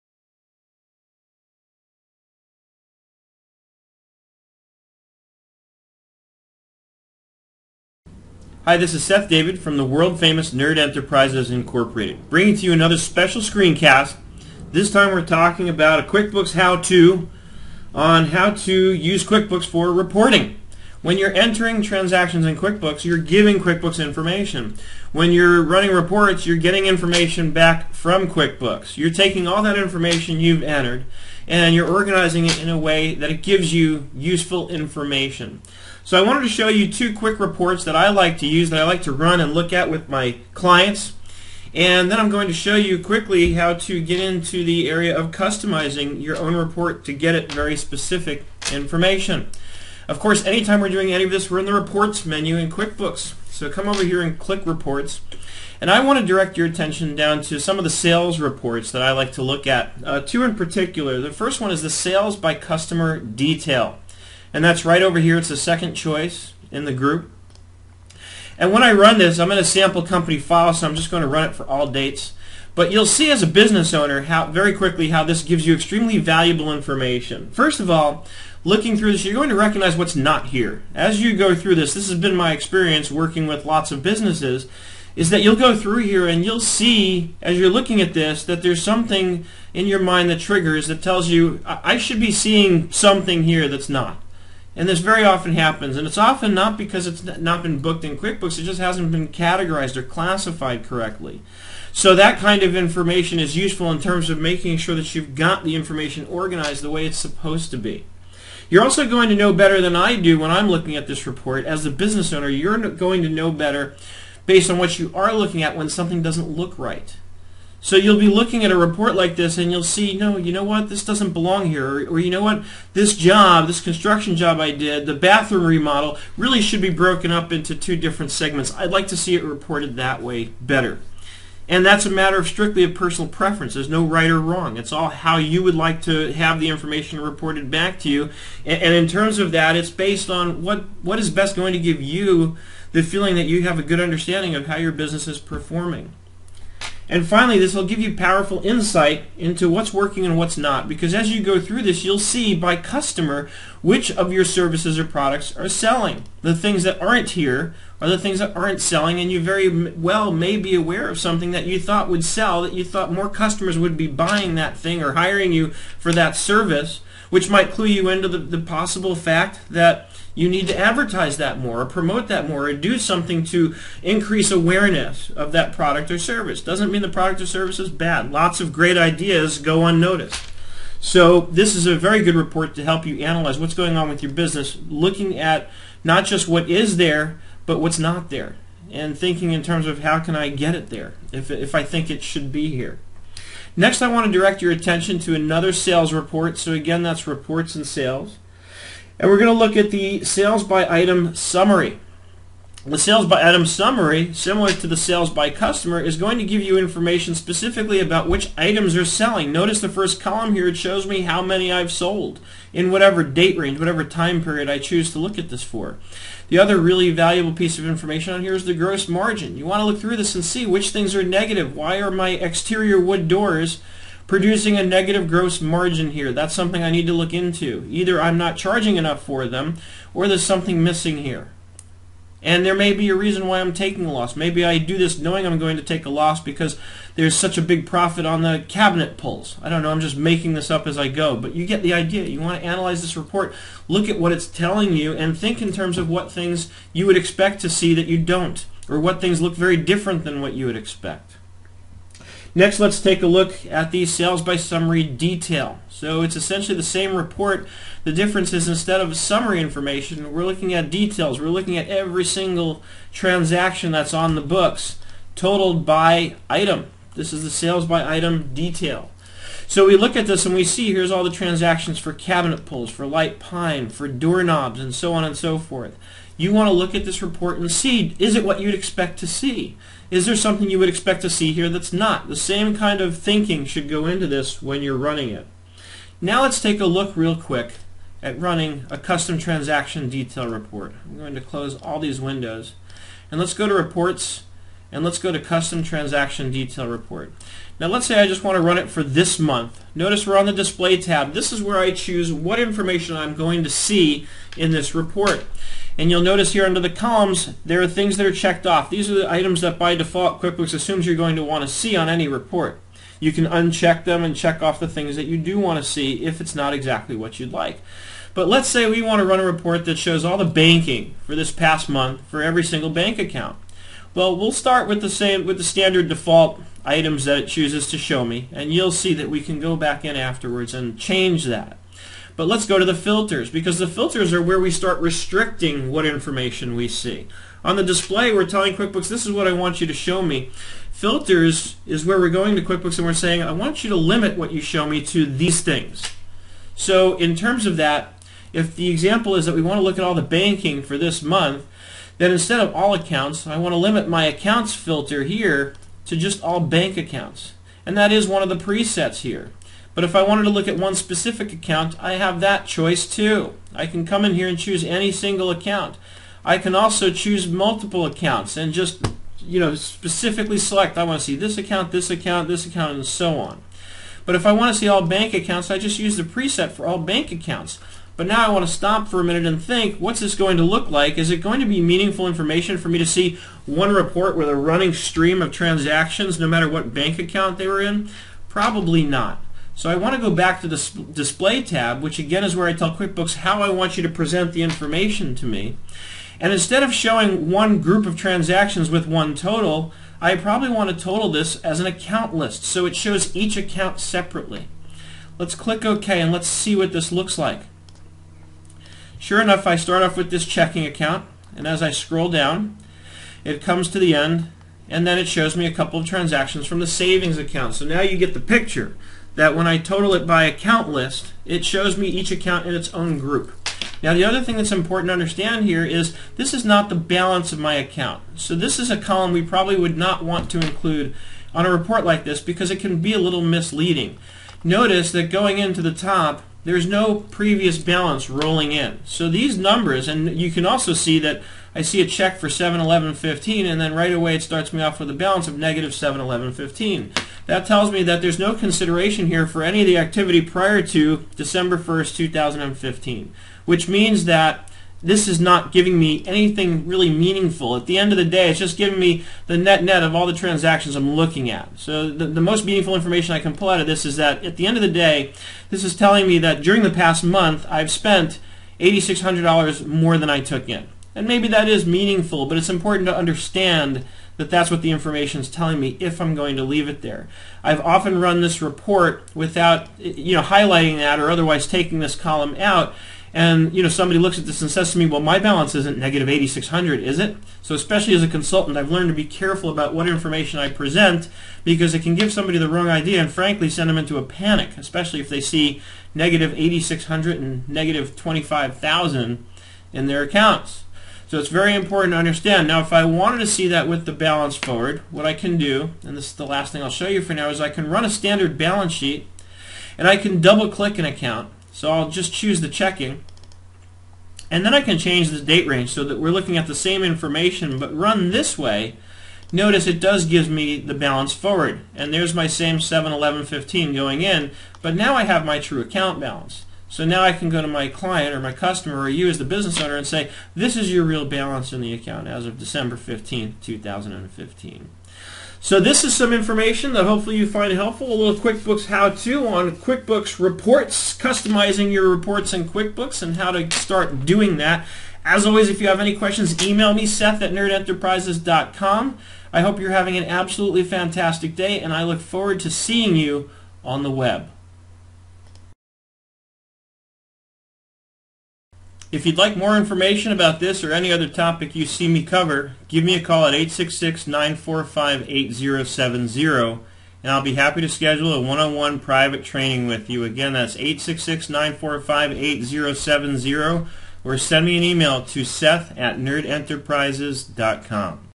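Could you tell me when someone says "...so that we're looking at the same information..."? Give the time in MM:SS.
08:35.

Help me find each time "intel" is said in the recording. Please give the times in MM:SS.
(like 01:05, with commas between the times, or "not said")
not said.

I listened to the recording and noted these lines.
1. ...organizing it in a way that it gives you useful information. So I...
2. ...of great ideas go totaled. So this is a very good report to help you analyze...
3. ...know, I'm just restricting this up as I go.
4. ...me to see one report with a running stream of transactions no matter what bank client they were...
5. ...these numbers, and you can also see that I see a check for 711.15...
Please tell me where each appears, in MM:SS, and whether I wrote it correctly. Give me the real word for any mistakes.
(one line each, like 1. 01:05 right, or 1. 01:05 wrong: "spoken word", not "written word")
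1. 00:31 right
2. 02:58 wrong: "unnoticed", not "totaled"
3. 03:59 wrong: "making", not "restricting"
4. 06:22 wrong: "account", not "client"
5. 07:19 right.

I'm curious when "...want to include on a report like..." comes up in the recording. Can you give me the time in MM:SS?
07:10.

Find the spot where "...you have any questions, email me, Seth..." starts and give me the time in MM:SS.
09:05.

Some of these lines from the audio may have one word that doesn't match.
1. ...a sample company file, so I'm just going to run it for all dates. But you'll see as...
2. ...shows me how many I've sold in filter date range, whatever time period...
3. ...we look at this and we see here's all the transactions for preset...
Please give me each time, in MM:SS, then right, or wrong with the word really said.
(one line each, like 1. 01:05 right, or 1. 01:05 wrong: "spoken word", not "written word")
1. 01:09 right
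2. 03:30 wrong: "whatever", not "filter"
3. 04:29 wrong: "cabinet", not "preset".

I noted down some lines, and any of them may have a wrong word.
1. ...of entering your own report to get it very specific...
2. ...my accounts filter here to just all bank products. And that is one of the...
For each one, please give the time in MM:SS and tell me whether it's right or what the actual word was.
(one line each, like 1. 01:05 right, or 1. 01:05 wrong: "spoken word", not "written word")
1. 00:45 wrong: "customizing", not "entering"
2. 05:54 wrong: "accounts", not "products".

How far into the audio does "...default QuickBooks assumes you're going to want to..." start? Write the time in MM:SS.
05:09.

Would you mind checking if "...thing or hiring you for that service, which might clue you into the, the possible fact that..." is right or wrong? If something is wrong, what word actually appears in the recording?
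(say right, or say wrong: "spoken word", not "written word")
right.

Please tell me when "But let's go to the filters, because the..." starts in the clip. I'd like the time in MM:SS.
05:32.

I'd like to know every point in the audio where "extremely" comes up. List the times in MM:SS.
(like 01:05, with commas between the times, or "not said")
01:15.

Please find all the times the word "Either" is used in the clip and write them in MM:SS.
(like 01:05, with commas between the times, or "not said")
03:47.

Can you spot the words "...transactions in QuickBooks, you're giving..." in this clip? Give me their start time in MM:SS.
00:21.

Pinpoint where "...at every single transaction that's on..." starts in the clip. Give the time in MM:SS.
04:21.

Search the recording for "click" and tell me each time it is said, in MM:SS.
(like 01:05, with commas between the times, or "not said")
00:54, 06:45, 08:30.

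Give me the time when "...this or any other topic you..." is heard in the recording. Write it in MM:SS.
09:20.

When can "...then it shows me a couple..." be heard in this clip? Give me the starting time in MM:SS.
06:55.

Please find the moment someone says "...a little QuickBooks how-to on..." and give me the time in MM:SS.
08:58.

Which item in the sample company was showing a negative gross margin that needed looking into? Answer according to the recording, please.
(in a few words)
exterior wood doors.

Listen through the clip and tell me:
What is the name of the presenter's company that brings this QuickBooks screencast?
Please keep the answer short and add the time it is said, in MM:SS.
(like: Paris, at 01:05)
Nerd Enterprises Incorporated, at 00:10.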